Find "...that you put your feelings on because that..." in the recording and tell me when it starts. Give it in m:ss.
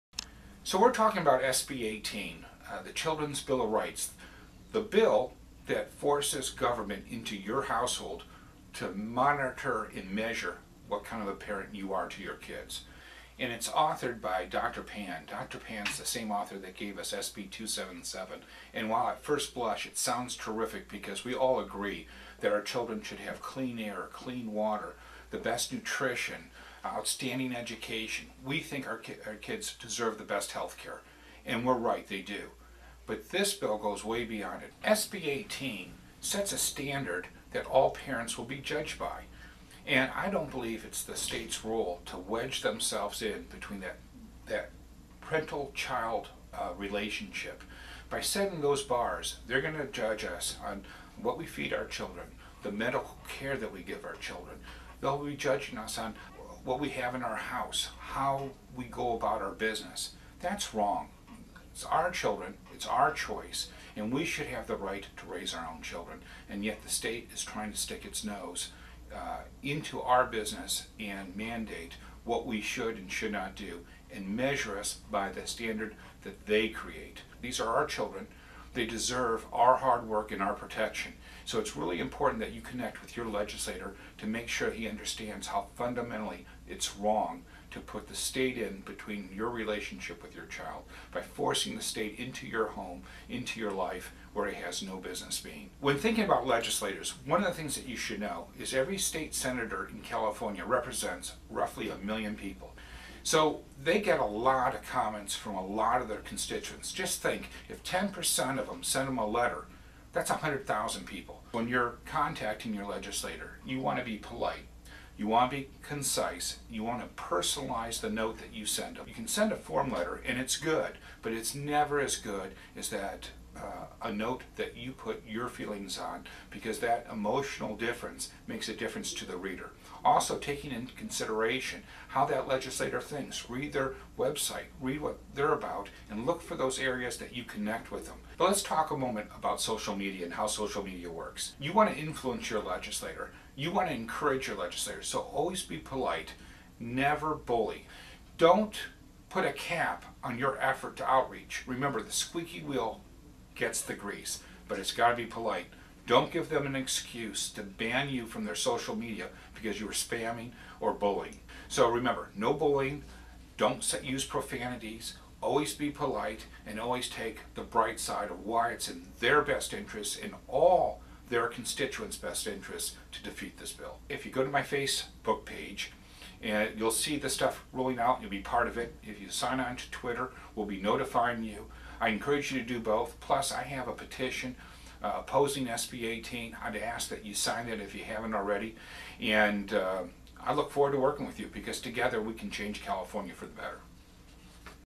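2:04.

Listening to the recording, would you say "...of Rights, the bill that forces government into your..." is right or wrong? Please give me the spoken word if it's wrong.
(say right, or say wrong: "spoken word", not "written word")
right.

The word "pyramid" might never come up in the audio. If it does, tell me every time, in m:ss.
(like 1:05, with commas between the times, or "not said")
not said.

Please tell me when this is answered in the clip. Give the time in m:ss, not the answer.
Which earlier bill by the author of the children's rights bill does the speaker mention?
0:17.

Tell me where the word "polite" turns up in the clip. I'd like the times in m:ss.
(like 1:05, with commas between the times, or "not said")
1:54, 2:25, 2:35, 2:45.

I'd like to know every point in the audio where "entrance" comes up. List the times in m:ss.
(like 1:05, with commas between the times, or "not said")
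not said.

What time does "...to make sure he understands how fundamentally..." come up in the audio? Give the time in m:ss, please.
1:24.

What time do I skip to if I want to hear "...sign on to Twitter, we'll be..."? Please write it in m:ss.
2:59.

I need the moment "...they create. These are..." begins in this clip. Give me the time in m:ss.
1:16.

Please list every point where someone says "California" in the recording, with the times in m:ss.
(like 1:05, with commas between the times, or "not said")
1:40, 3:12.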